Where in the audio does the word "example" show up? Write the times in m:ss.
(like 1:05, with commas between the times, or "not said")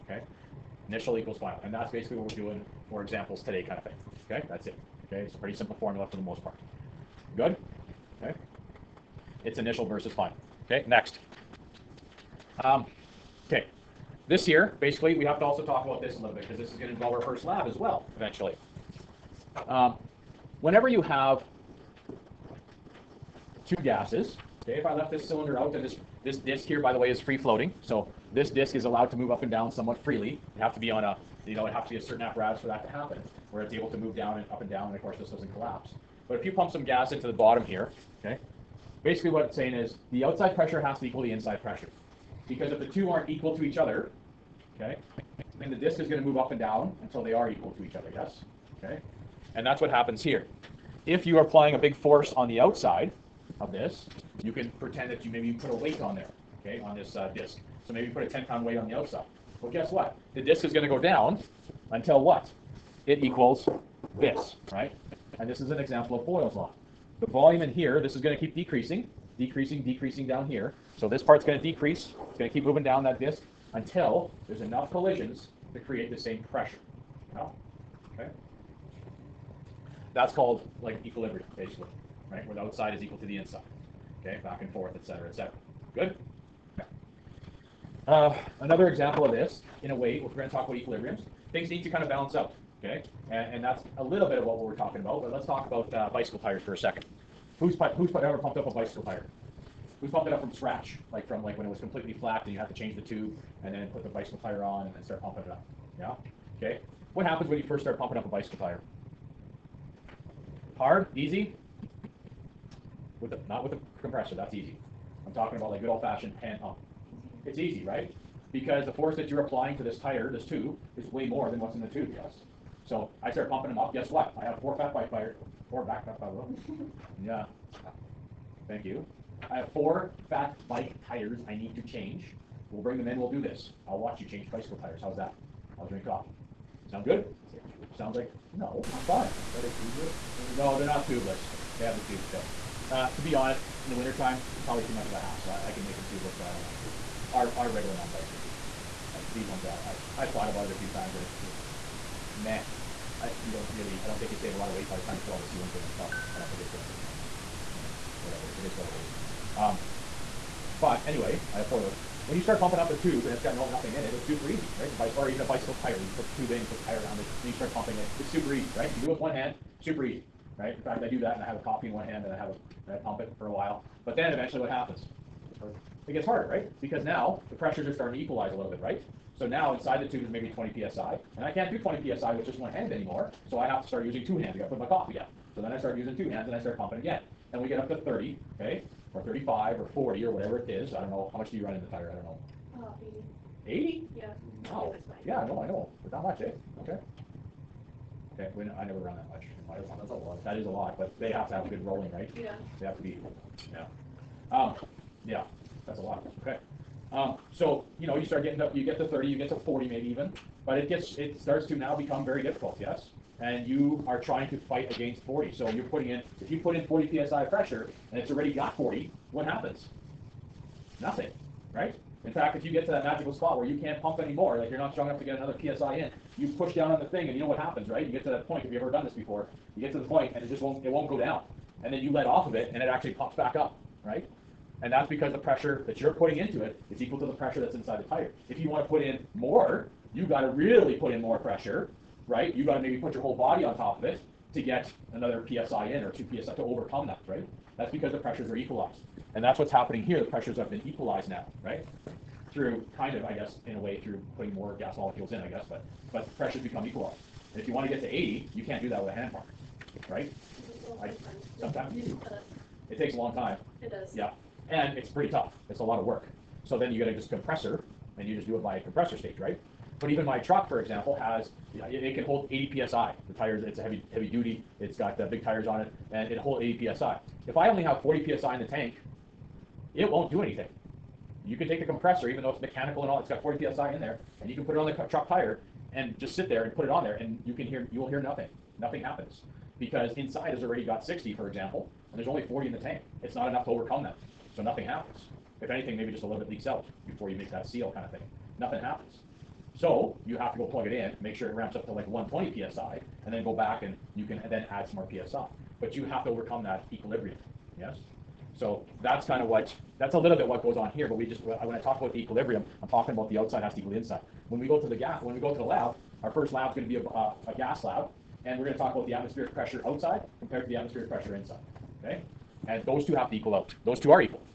0:03, 1:05, 1:28, 4:30, 4:51.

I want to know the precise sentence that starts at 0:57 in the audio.
So maybe you put a 10-pound weight on the outside.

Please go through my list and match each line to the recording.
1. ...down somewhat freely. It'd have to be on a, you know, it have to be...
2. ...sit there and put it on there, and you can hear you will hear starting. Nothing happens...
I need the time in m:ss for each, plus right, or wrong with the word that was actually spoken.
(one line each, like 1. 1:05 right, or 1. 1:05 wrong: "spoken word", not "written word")
1. 0:29 right
2. 4:46 wrong: "nothing", not "starting".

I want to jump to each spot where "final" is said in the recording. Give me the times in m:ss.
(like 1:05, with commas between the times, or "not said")
0:01, 0:10.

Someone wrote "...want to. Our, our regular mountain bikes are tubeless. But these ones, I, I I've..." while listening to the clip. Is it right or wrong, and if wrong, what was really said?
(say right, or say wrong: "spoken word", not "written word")
right.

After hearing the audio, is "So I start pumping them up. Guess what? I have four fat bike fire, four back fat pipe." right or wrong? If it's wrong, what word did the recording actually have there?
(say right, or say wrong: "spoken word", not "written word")
right.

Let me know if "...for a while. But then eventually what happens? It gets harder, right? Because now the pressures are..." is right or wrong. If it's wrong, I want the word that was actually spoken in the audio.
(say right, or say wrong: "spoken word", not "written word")
right.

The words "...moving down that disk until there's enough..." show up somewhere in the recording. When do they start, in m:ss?
1:12.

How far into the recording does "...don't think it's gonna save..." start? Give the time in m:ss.
2:36.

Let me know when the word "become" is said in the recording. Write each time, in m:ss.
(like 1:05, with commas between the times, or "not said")
3:31, 4:16.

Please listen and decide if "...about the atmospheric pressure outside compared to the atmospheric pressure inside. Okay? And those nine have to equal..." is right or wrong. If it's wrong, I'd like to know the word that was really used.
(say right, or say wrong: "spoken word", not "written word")
wrong: "two", not "nine".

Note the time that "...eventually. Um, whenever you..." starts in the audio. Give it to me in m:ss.
0:18.